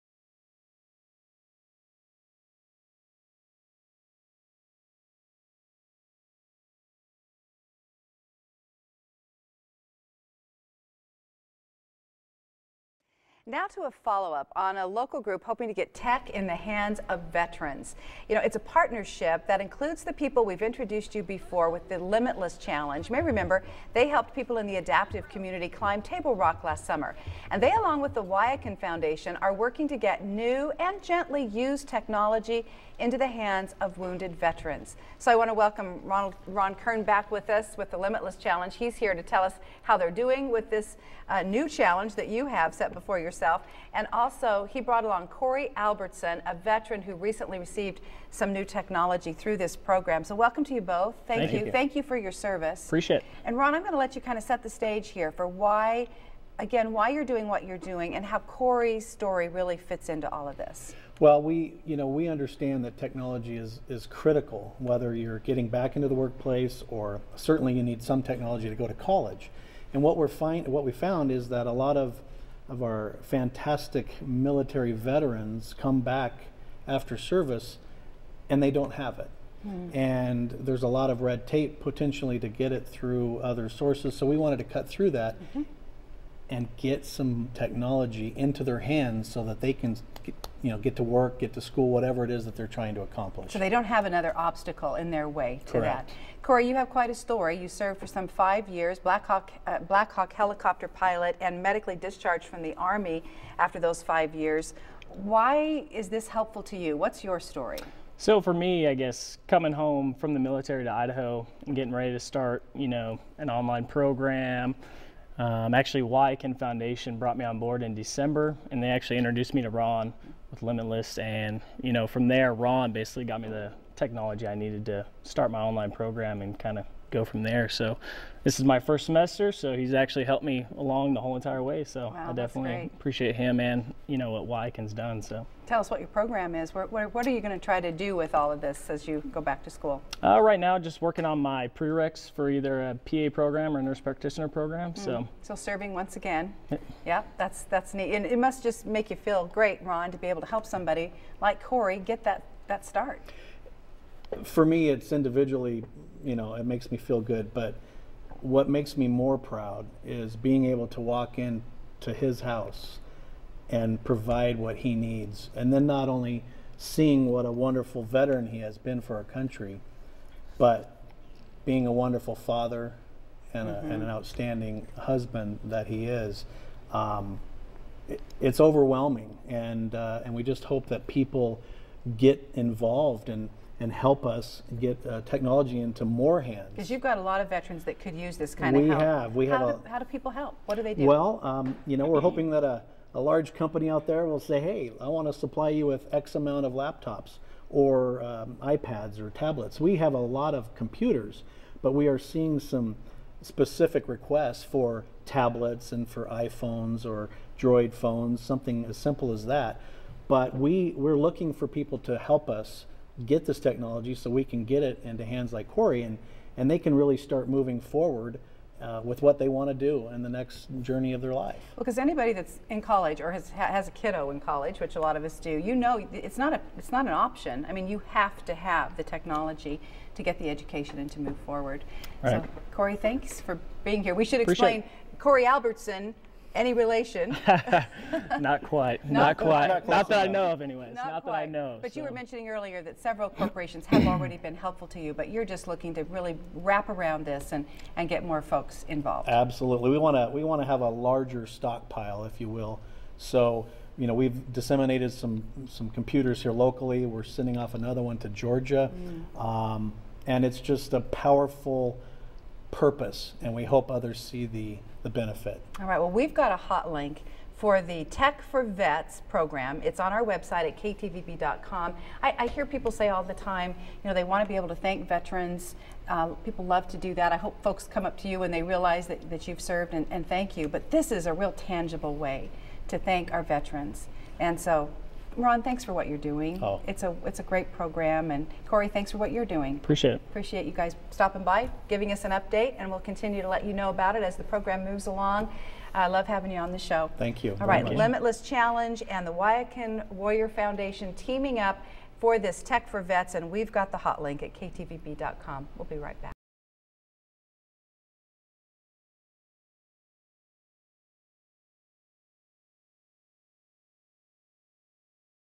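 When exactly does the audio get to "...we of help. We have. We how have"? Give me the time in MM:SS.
03:08.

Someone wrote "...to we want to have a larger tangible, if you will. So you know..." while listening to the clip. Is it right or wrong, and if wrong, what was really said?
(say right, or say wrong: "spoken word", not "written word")
wrong: "stockpile", not "tangible".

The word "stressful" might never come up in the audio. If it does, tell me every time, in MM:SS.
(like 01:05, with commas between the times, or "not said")
not said.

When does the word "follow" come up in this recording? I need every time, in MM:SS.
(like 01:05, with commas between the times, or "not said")
00:13.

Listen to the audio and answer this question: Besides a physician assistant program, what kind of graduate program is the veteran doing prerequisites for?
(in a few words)
nurse practitioner.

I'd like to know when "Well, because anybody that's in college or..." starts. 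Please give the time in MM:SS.
03:41.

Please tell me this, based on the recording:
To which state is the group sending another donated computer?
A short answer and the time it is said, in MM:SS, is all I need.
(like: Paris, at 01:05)
Georgia, at 04:18.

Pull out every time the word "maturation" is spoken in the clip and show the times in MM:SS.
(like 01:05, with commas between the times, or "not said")
not said.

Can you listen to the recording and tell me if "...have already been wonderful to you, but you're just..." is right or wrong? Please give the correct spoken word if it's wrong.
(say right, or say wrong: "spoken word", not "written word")
wrong: "helpful", not "wonderful".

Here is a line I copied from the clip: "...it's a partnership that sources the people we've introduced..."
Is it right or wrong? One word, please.
wrong.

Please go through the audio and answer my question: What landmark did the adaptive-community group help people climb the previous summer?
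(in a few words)
Table Rock.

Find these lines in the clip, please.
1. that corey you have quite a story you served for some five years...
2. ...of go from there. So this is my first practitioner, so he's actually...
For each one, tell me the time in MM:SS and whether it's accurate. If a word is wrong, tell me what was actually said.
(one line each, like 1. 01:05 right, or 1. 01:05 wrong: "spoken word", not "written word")
1. 01:36 right
2. 02:06 wrong: "semester", not "practitioner".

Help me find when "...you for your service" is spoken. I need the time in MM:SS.
00:51.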